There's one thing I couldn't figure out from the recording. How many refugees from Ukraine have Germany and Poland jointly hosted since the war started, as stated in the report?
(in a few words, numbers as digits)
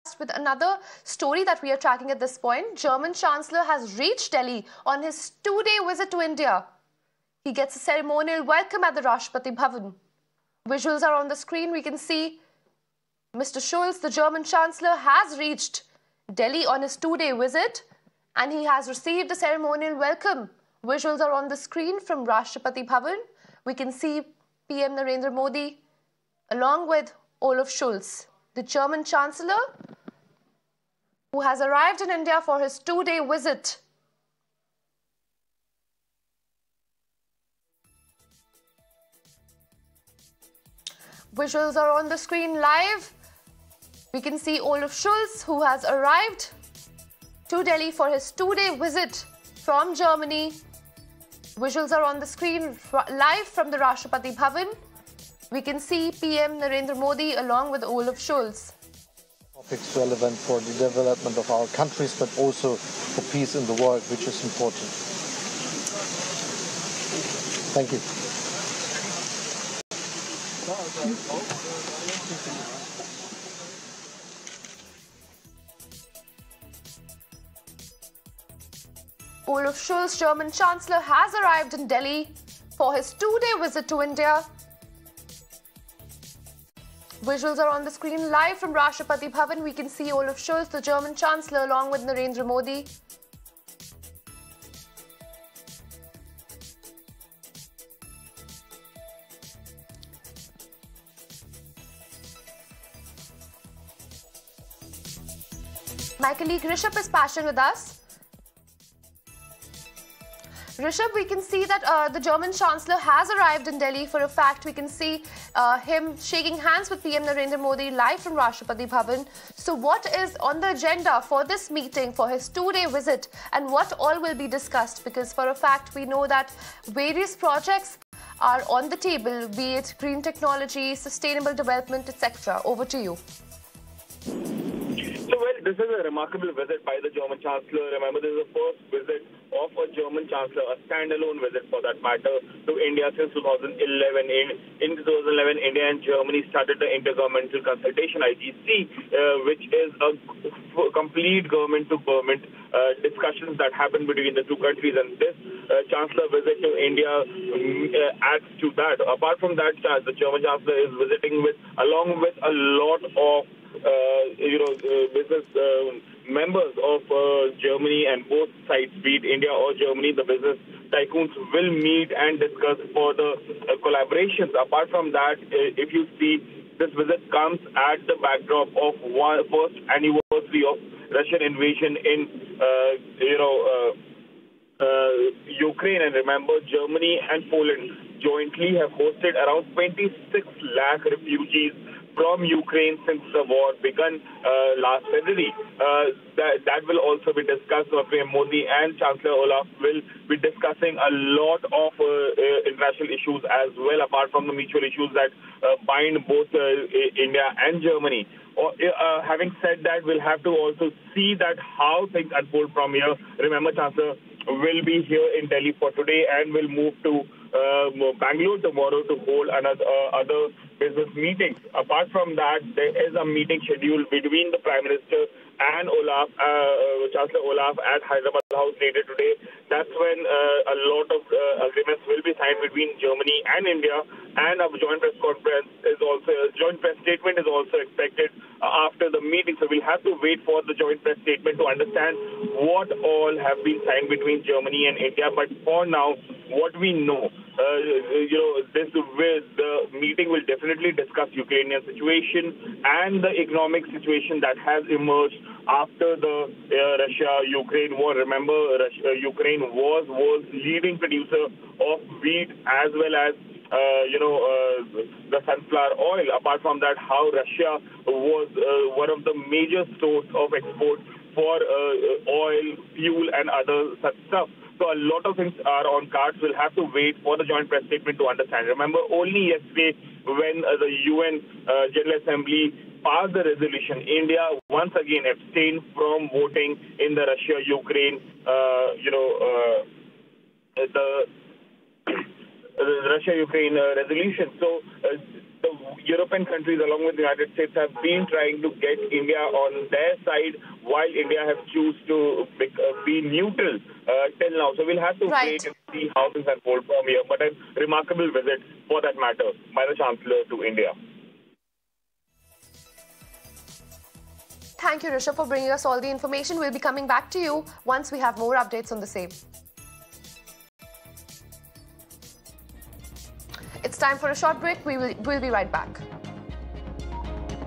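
26 lakh.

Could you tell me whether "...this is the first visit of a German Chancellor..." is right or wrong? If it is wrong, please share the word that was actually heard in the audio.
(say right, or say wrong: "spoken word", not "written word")
right.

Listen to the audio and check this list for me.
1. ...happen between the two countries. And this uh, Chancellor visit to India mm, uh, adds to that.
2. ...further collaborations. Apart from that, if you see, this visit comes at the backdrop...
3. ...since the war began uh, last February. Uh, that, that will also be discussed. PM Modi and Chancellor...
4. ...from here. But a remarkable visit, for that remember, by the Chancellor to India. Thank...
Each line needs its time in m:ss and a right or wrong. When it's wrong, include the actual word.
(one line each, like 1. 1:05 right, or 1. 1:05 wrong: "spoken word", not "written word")
1. 2:33 right
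2. 2:52 right
3. 3:13 right
4. 5:06 wrong: "matter", not "remember".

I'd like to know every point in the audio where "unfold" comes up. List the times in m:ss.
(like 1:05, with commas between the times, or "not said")
3:32, 5:06.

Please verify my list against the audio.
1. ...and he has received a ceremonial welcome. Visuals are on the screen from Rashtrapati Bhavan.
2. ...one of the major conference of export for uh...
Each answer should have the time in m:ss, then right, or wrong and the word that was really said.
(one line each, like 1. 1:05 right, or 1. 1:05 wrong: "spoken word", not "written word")
1. 0:18 right
2. 4:28 wrong: "source", not "conference".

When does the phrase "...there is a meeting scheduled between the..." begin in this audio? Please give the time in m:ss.
3:42.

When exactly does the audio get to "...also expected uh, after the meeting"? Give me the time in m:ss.
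3:57.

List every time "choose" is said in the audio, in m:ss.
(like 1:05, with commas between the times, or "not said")
5:01.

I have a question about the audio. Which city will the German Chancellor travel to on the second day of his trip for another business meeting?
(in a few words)
Bangalore.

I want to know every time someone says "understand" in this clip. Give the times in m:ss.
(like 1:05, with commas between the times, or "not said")
4:01, 4:38.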